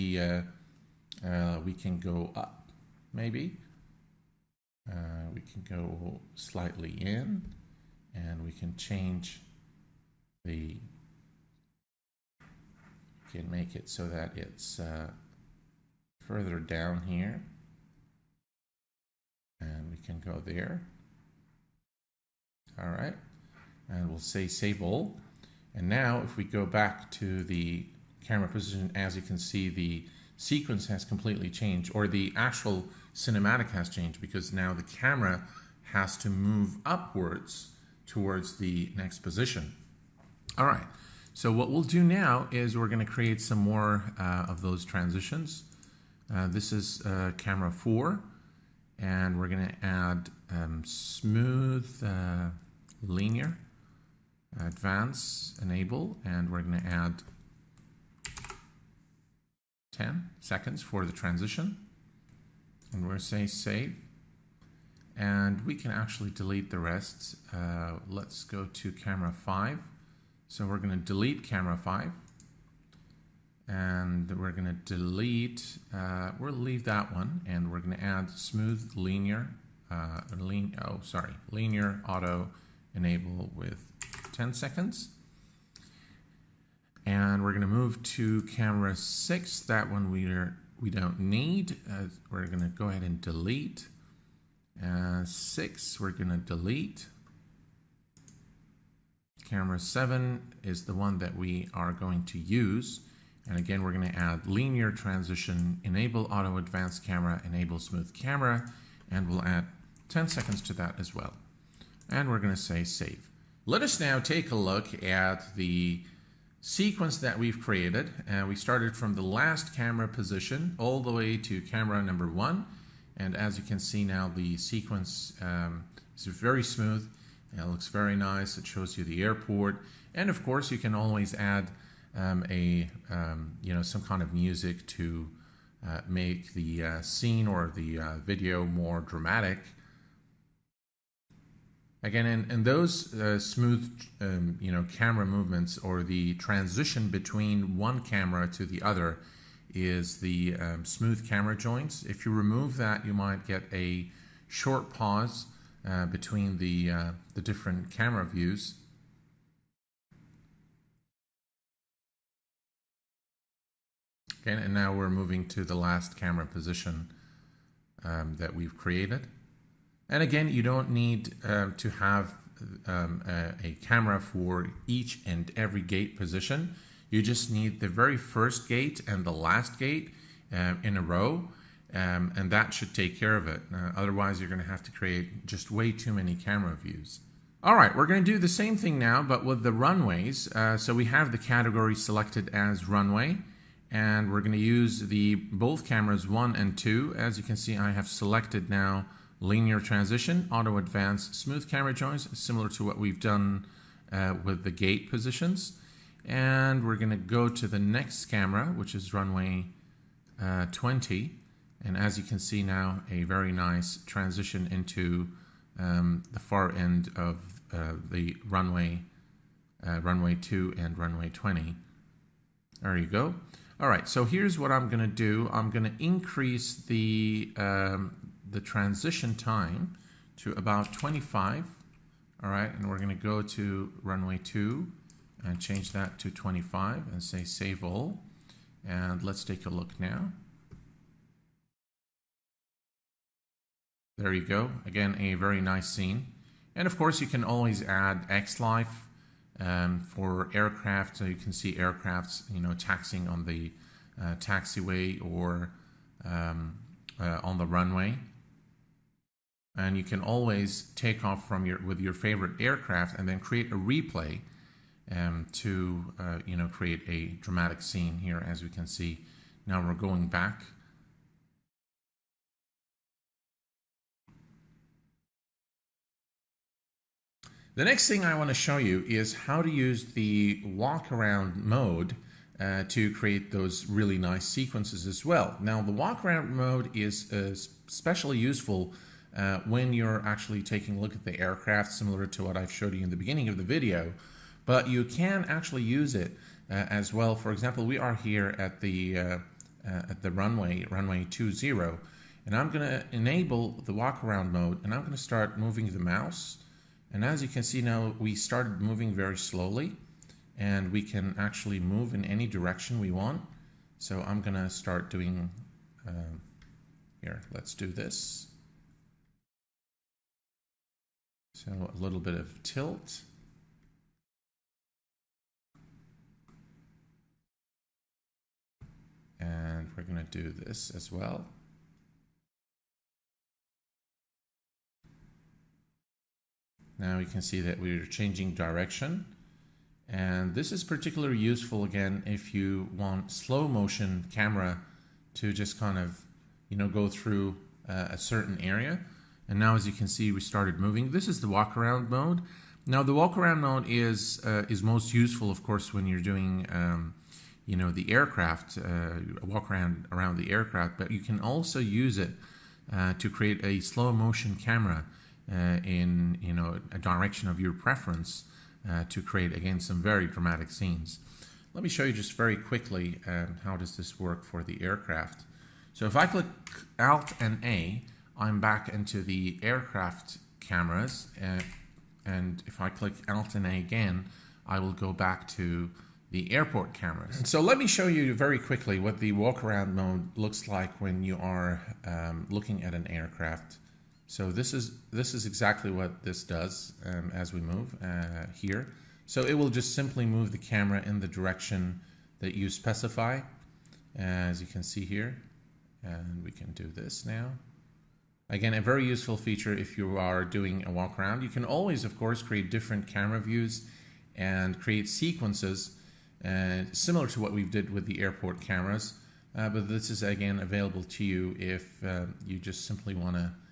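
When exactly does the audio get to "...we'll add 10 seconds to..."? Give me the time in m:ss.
1:49.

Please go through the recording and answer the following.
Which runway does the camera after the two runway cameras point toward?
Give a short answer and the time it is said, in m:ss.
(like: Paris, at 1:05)
Runway 20, at 3:29.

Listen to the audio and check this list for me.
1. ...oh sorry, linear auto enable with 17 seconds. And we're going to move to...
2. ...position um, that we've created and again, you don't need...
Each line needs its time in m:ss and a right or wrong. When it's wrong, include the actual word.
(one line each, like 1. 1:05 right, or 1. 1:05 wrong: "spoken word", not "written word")
1. 1:20 wrong: "10", not "17"
2. 2:46 right.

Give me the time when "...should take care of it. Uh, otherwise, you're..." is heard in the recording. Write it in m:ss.
3:02.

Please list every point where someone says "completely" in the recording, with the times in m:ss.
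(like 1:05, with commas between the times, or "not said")
0:31.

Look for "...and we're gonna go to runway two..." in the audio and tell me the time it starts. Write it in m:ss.
3:52.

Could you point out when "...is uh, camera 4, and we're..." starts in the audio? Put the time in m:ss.
0:46.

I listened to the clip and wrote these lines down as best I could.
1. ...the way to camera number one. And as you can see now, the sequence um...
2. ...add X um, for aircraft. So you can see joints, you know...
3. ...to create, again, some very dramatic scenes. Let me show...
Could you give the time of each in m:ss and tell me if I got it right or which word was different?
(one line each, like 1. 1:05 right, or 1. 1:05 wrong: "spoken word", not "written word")
1. 2:00 right
2. 4:07 wrong: "aircrafts", not "joints"
3. 6:09 right.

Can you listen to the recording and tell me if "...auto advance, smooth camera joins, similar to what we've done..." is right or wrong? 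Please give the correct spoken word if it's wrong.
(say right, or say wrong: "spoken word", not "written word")
right.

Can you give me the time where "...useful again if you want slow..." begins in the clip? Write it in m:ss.
5:41.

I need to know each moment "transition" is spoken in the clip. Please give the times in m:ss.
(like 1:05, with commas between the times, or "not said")
0:44, 1:01, 1:44, 2:26, 3:19, 3:34, 3:48.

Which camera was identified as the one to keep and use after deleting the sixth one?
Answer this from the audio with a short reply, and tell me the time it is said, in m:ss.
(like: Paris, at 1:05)
Camera 7, at 1:39.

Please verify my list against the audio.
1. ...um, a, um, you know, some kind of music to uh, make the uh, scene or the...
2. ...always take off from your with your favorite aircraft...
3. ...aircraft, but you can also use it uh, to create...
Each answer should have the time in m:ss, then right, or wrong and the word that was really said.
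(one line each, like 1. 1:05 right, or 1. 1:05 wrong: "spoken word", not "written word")
1. 2:12 right
2. 4:20 right
3. 6:00 right.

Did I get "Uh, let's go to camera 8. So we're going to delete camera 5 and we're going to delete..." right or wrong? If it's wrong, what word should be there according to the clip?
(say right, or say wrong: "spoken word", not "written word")
wrong: "5", not "8".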